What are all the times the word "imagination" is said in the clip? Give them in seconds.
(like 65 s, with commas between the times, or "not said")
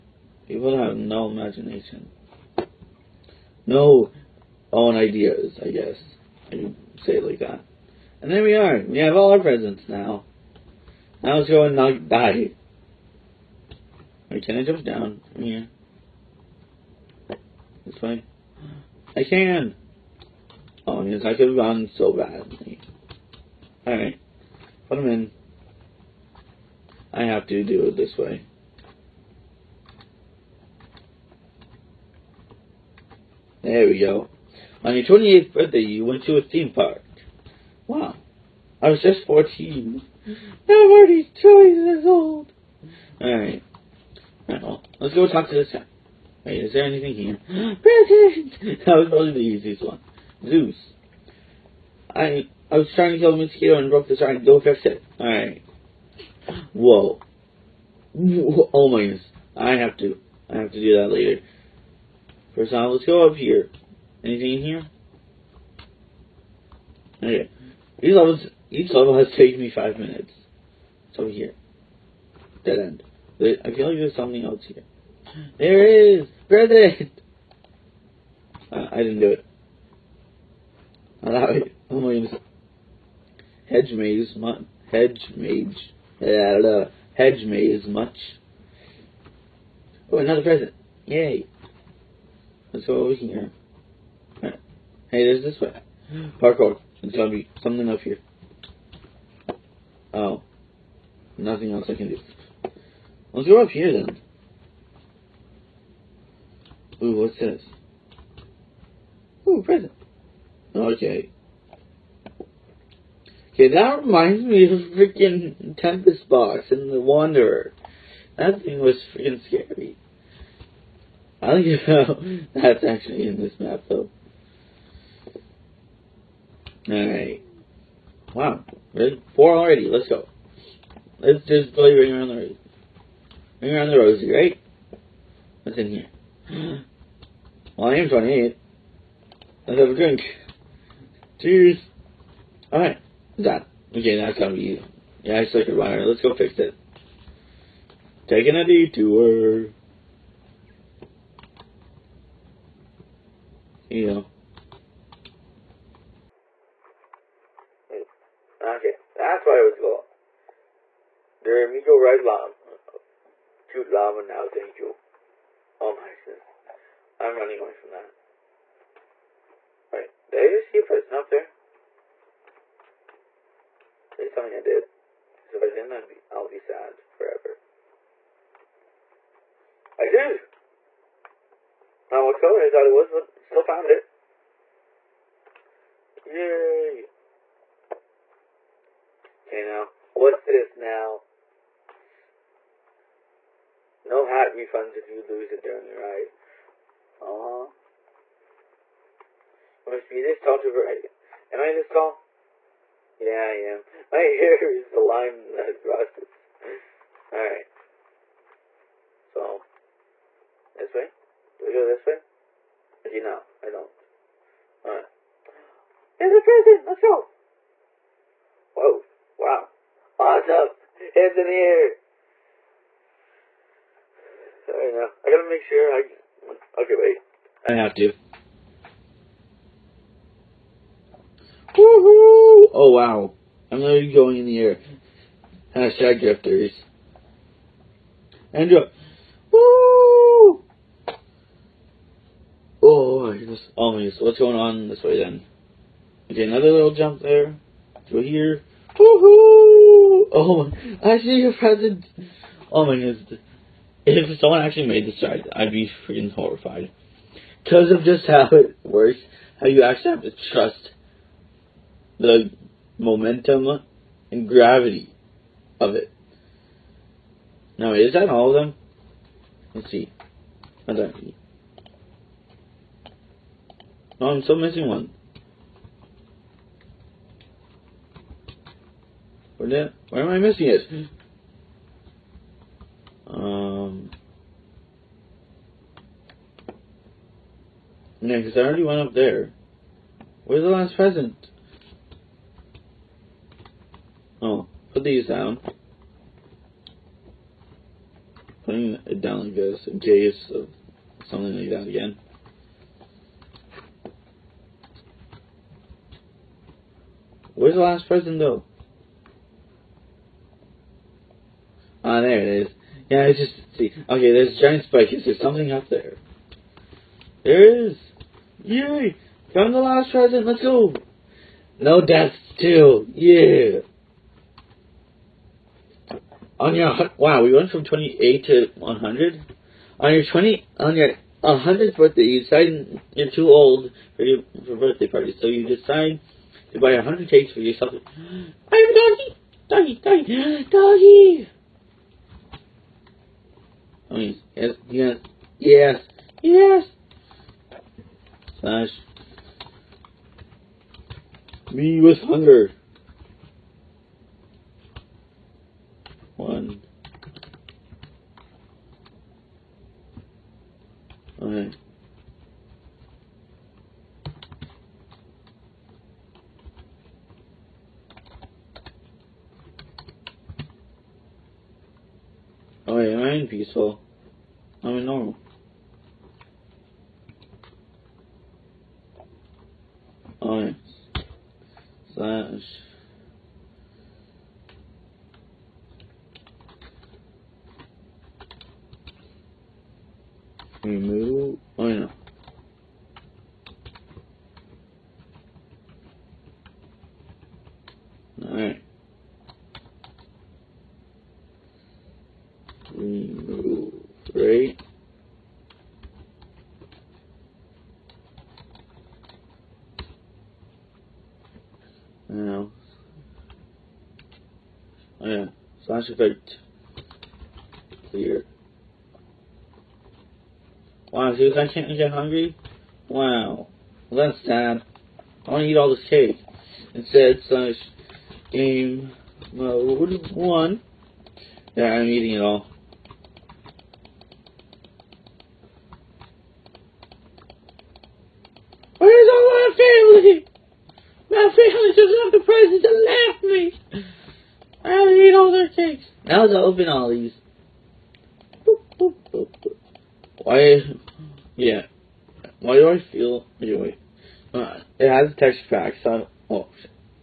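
1 s.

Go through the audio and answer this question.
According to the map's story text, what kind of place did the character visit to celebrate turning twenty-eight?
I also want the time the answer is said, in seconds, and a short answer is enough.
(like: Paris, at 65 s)
theme park, at 36 s.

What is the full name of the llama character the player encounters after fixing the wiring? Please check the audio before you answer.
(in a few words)
The Amigo Red Llama.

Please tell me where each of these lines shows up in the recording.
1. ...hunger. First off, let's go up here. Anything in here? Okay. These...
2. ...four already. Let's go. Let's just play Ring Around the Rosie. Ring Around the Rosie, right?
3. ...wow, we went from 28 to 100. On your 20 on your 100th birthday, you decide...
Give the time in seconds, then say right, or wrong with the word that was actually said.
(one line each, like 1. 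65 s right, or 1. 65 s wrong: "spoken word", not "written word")
1. 61 s wrong: "later", not "hunger"
2. 129 s right
3. 327 s right.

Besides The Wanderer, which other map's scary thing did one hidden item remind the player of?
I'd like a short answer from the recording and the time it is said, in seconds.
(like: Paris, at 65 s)
Tempest Box, at 115 s.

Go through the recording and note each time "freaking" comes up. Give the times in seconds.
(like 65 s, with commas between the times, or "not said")
114 s, 119 s, 256 s.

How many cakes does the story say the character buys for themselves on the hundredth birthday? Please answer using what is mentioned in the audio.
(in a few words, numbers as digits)
100.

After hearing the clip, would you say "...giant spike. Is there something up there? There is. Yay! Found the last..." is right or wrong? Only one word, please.
right.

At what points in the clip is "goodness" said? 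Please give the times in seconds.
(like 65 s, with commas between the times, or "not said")
59 s, 82 s, 166 s, 243 s, 252 s.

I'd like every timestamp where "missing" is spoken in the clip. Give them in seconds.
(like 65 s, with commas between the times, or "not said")
274 s, 280 s.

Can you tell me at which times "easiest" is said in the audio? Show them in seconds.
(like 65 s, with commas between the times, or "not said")
49 s.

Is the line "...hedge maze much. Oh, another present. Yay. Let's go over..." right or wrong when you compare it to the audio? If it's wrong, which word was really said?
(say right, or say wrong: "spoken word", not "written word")
right.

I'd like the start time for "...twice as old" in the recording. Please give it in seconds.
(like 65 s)
41 s.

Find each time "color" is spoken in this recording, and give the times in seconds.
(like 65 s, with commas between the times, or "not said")
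182 s.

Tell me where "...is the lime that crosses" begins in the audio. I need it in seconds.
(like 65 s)
204 s.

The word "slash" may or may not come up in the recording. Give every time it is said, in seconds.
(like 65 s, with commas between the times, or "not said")
348 s, 415 s, 427 s.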